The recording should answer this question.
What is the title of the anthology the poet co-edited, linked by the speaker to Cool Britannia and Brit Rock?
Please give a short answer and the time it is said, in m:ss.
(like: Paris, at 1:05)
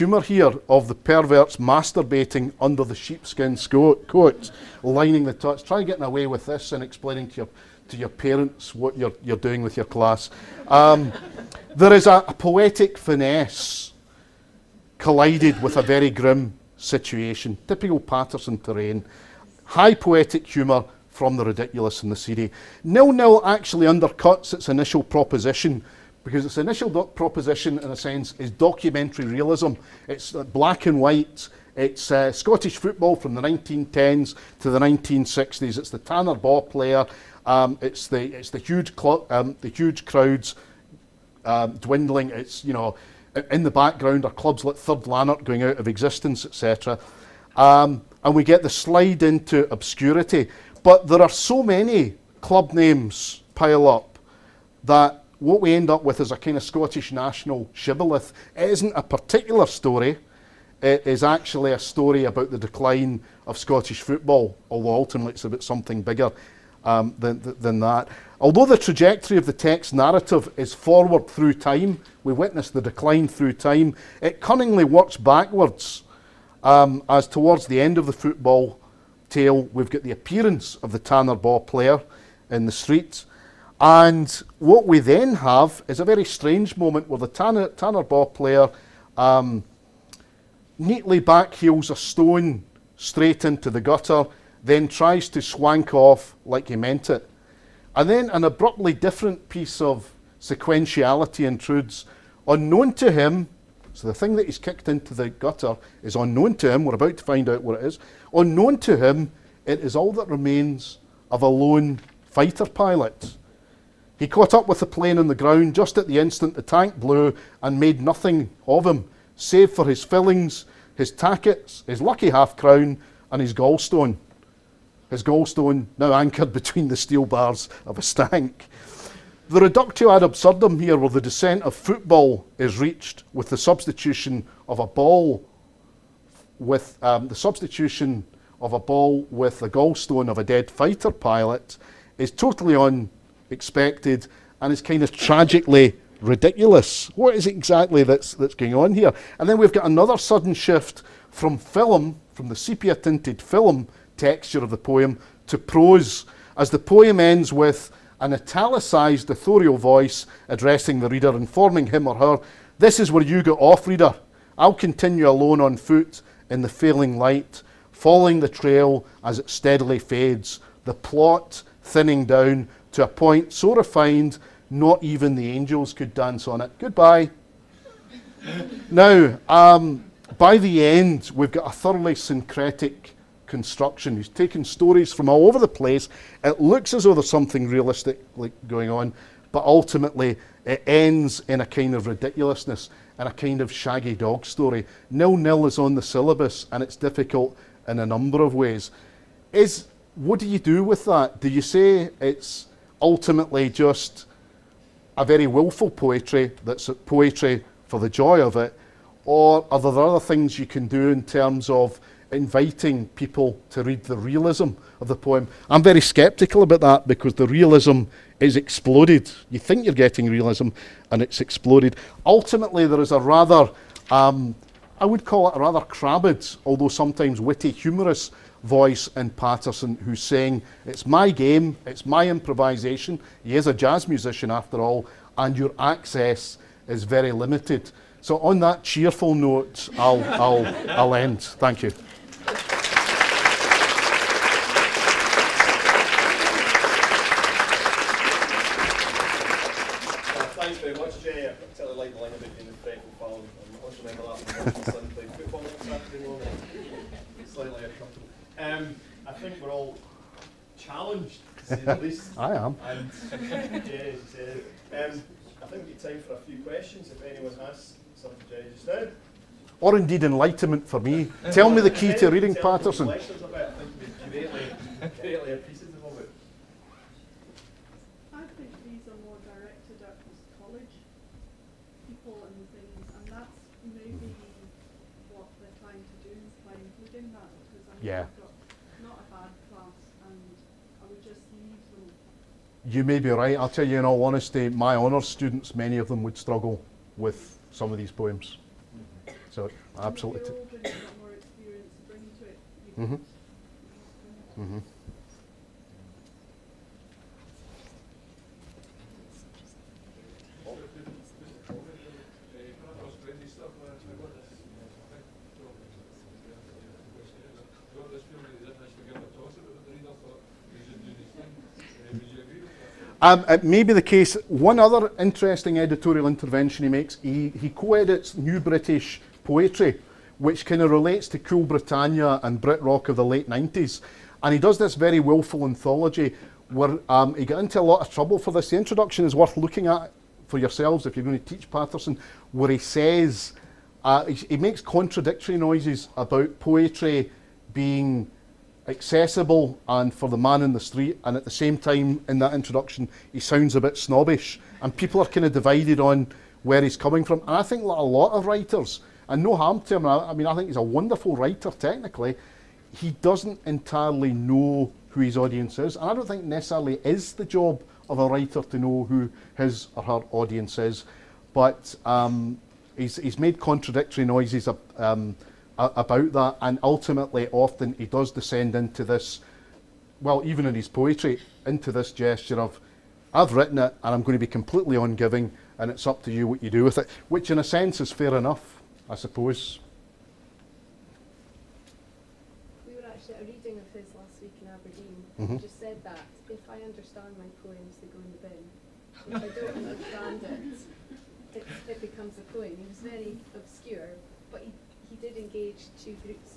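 New British Poetry, at 5:28.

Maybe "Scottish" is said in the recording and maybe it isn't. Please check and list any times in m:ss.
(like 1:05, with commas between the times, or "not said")
0:32, 0:56, 1:03.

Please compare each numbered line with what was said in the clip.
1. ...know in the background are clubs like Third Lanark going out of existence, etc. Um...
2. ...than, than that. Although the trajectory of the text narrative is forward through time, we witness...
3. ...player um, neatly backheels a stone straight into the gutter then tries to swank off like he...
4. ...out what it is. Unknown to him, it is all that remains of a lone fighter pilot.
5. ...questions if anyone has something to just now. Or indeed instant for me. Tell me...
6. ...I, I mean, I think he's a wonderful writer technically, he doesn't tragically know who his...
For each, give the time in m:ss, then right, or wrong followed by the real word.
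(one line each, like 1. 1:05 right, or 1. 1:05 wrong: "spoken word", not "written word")
1. 0:42 right
2. 1:07 right
3. 1:28 right
4. 1:47 right
5. 4:26 wrong: "enlightenment", not "instant"
6. 6:00 wrong: "entirely", not "tragically".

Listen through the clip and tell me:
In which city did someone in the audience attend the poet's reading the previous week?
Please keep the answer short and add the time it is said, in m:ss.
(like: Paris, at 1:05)
Aberdeen, at 6:34.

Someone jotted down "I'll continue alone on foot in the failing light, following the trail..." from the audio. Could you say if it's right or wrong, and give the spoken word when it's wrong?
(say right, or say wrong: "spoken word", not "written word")
right.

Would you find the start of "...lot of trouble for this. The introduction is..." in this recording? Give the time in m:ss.
5:37.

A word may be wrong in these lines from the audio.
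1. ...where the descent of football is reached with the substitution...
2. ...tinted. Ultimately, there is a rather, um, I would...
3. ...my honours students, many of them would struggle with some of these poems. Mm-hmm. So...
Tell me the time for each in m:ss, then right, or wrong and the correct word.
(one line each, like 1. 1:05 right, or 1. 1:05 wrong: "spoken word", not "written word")
1. 2:10 right
2. 3:41 wrong: "exploded", not "tinted"
3. 4:54 right.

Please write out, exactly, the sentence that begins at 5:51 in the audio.
And at the same time, in that introduction, he sounds a bit snobbish.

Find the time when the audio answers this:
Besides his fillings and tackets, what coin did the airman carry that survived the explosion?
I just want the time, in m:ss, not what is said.
2:01.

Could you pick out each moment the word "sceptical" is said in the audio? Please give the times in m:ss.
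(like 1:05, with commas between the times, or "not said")
3:35.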